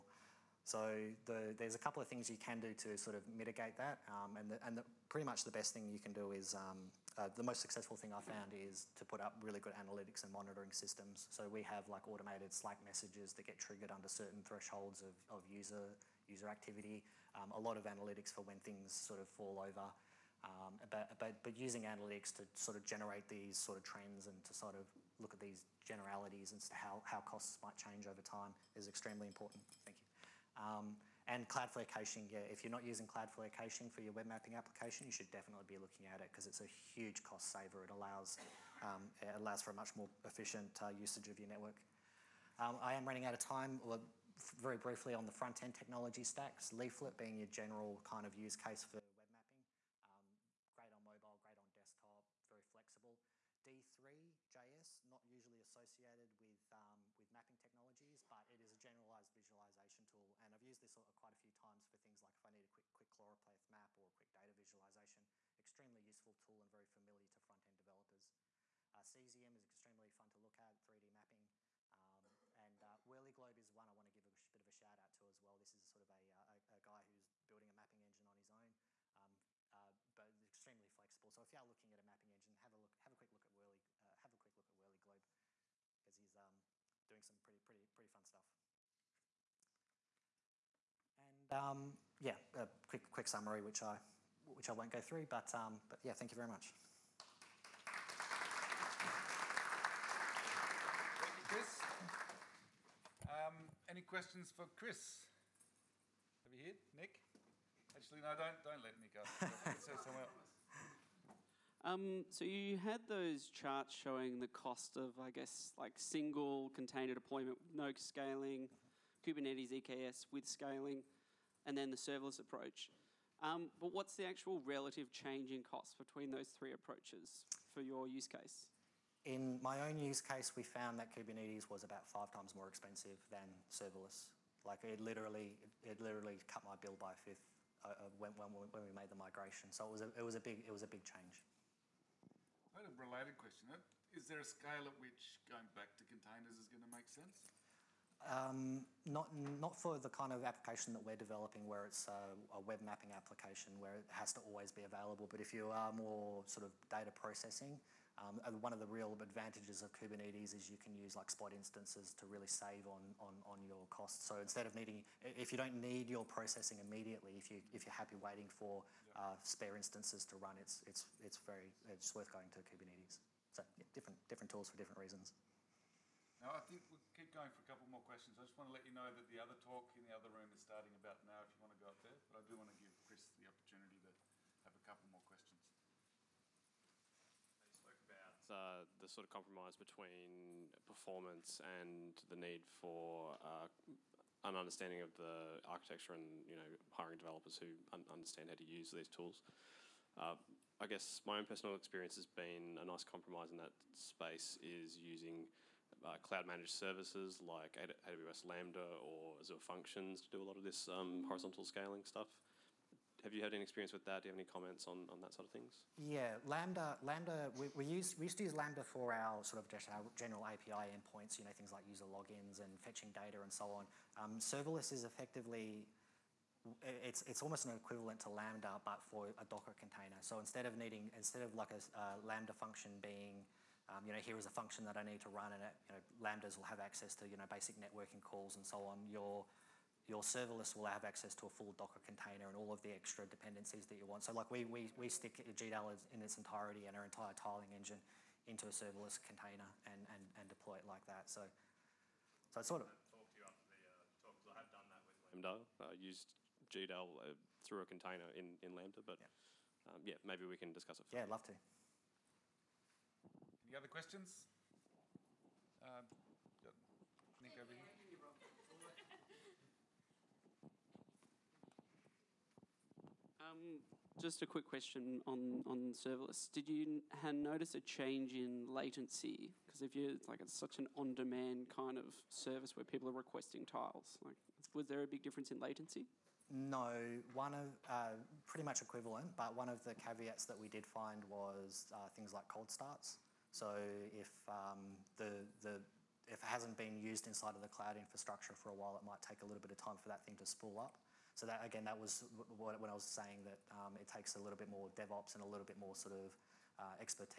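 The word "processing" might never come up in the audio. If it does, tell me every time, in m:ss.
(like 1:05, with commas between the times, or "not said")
2:37, 2:46.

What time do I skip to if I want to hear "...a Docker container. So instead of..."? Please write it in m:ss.
3:49.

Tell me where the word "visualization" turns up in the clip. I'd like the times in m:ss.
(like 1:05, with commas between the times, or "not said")
0:59, 1:04.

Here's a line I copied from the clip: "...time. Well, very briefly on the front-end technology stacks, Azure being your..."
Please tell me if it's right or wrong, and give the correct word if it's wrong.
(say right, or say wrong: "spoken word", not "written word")
wrong: "Leaflet", not "Azure".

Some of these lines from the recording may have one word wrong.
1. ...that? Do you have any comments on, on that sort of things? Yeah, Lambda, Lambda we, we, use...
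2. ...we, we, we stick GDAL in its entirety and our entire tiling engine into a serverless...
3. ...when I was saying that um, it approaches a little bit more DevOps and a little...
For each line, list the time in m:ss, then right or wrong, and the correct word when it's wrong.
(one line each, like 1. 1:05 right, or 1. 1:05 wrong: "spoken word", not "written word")
1. 3:34 right
2. 4:04 right
3. 5:02 wrong: "takes", not "approaches".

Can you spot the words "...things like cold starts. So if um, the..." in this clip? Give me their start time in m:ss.
4:52.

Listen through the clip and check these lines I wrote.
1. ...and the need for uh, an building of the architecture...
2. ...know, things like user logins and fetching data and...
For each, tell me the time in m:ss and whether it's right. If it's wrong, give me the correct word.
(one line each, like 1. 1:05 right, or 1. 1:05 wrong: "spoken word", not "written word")
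1. 3:11 wrong: "understanding", not "building"
2. 3:41 right.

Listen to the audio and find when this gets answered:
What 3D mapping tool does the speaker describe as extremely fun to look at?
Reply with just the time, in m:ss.
1:08.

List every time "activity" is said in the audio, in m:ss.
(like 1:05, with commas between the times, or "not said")
0:16.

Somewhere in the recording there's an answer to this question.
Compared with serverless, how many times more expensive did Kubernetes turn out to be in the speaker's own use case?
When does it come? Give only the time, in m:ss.
2:12.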